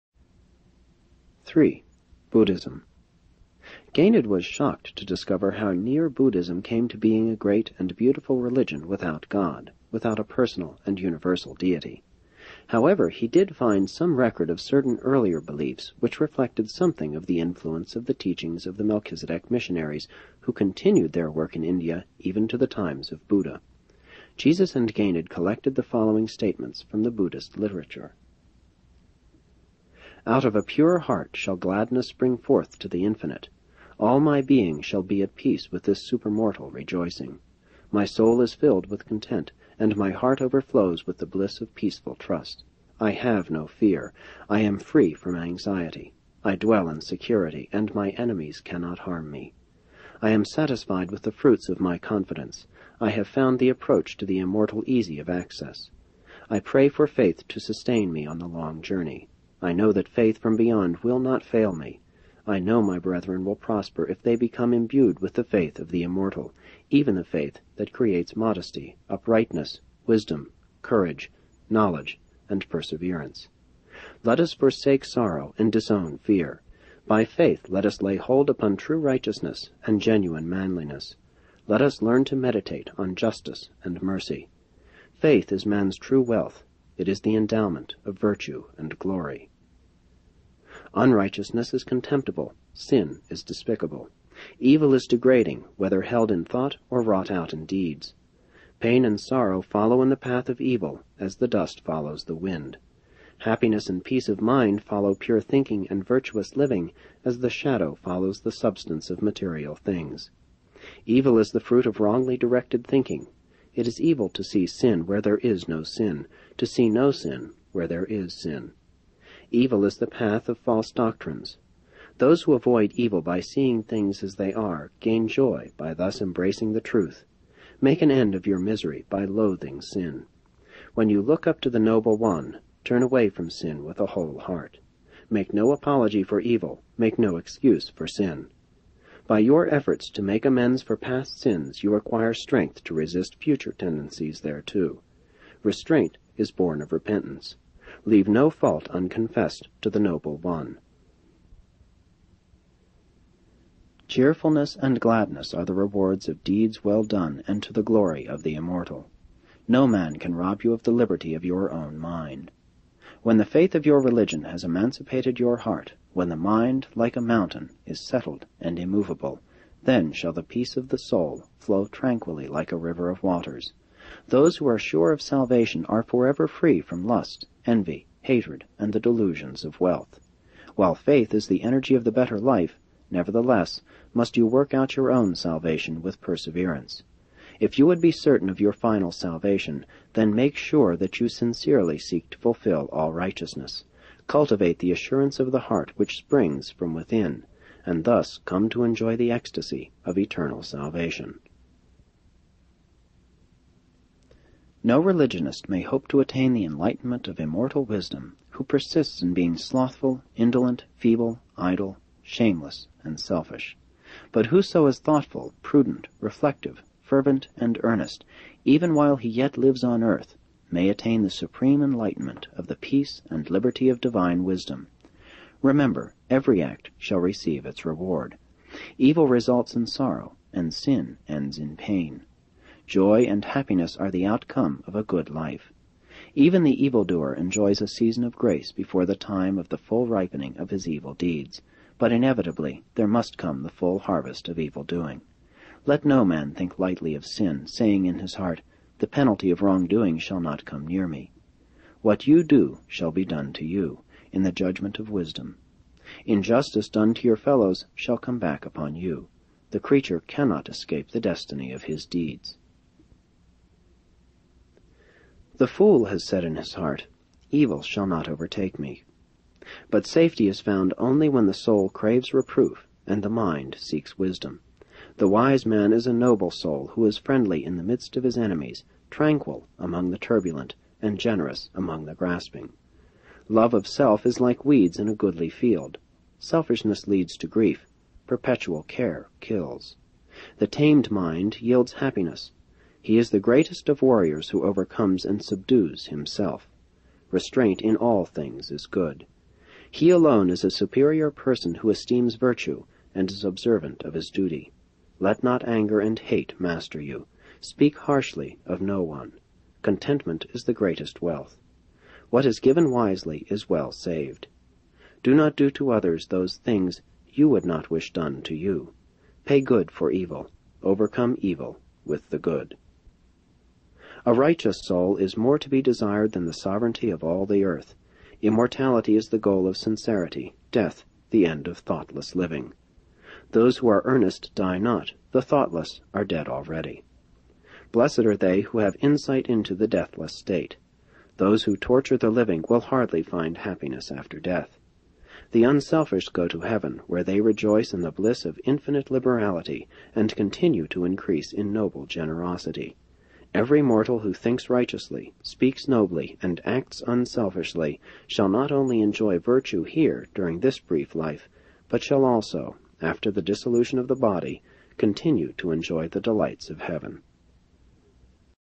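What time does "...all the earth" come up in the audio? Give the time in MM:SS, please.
05:27.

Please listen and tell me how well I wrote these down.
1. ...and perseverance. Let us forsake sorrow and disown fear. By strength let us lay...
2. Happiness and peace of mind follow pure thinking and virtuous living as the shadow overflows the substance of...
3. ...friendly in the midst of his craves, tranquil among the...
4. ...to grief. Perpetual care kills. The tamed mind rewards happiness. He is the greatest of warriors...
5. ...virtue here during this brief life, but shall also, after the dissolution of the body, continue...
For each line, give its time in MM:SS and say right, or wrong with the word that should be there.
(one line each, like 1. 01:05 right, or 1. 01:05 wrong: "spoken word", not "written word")
1. 01:12 wrong: "faith", not "strength"
2. 01:43 wrong: "follows", not "overflows"
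3. 04:37 wrong: "enemies", not "craves"
4. 04:47 wrong: "yields", not "rewards"
5. 05:59 right.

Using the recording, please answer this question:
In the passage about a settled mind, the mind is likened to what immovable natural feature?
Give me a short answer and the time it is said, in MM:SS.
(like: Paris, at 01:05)
A mountain, at 02:47.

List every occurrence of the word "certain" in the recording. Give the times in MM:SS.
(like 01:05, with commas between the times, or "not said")
00:14, 03:08.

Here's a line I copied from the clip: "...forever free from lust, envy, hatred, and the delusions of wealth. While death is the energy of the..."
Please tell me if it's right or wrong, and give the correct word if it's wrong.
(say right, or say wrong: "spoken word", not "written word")
wrong: "faith", not "death".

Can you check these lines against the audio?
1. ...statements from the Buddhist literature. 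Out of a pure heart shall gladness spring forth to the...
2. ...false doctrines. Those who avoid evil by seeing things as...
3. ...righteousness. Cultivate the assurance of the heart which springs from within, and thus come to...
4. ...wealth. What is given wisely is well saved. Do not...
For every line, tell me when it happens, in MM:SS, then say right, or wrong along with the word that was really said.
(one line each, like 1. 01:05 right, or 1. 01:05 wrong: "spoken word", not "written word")
1. 00:26 right
2. 02:00 right
3. 03:13 right
4. 05:11 right.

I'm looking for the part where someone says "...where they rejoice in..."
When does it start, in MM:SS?
05:47.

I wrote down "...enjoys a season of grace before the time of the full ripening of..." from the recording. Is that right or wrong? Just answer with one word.
right.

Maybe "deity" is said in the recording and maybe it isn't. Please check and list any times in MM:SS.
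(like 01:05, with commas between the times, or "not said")
00:11.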